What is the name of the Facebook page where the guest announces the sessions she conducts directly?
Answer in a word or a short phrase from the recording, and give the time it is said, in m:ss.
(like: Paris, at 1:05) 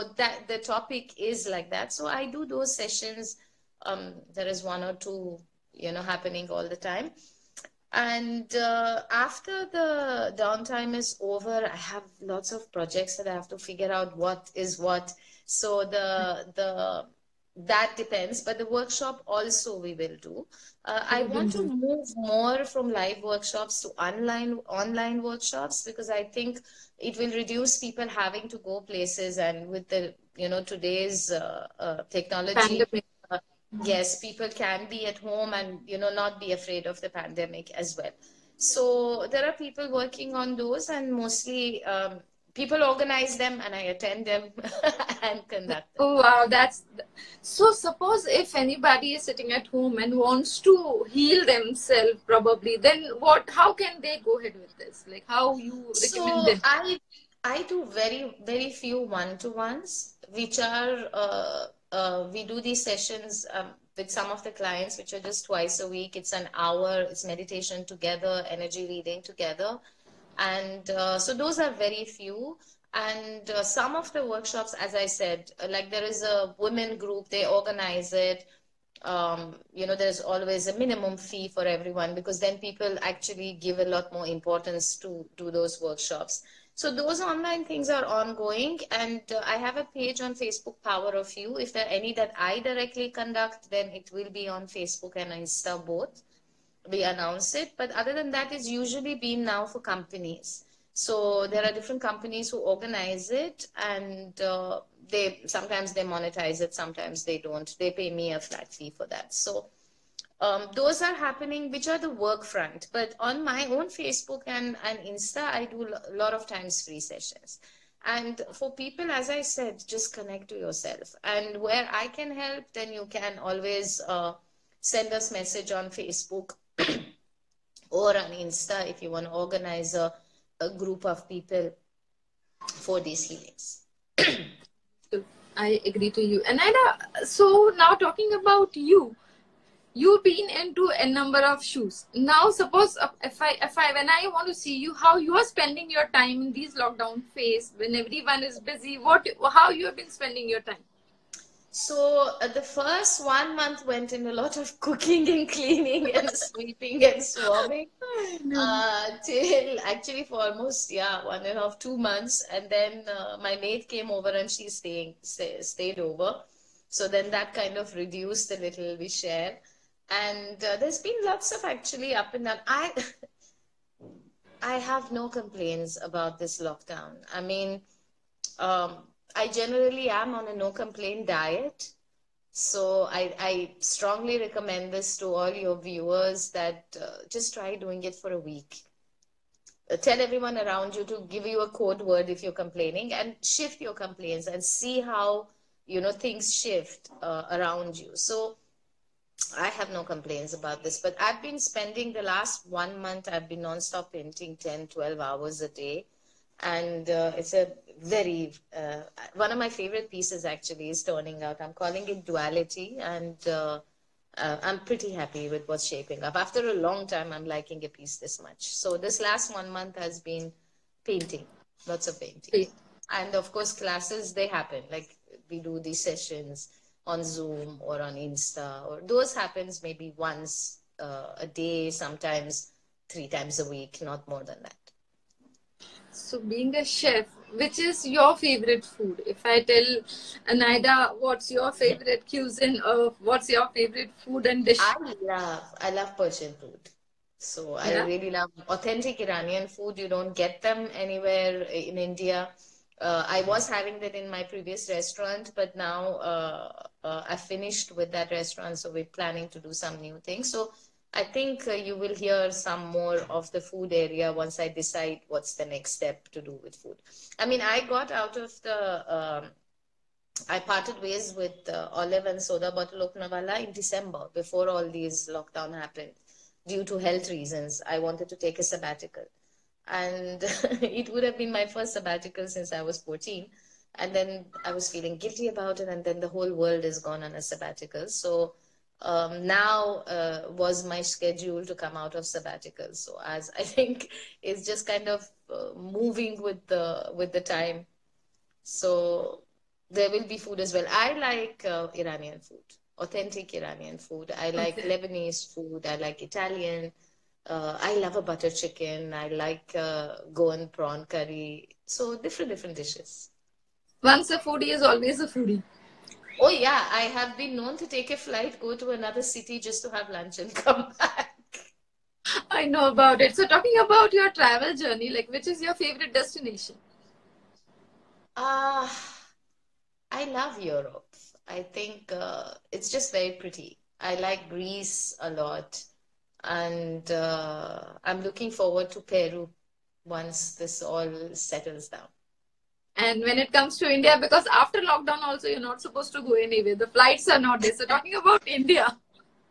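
Power of You, at 1:30.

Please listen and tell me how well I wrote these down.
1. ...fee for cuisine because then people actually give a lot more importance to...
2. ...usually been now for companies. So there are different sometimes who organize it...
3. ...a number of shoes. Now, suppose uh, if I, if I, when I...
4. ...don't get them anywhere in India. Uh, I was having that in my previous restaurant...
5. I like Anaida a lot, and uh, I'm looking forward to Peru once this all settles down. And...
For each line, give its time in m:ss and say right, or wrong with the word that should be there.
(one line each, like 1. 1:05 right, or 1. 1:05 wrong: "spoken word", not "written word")
1. 1:21 wrong: "everyone", not "cuisine"
2. 1:38 wrong: "companies", not "sometimes"
3. 2:20 right
4. 4:10 right
5. 5:33 wrong: "Greece", not "Anaida".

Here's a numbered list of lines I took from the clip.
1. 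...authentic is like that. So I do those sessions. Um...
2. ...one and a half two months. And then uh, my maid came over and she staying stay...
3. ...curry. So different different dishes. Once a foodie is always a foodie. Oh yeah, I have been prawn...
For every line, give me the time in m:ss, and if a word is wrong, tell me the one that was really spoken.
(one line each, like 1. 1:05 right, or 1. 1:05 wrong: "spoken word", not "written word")
1. 0:00 wrong: "topic", not "authentic"
2. 2:41 right
3. 5:11 wrong: "known", not "prawn".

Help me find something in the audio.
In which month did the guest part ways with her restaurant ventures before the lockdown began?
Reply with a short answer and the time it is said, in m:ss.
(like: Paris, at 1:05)
December, at 4:33.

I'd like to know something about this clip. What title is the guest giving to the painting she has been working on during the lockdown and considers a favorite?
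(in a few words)
Duality.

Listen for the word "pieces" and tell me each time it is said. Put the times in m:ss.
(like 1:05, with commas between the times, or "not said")
3:30, 3:37.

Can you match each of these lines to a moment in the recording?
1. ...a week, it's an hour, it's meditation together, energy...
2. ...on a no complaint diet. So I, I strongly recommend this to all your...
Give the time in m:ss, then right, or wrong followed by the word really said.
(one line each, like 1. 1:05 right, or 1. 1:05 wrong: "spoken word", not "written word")
1. 1:05 right
2. 3:00 right.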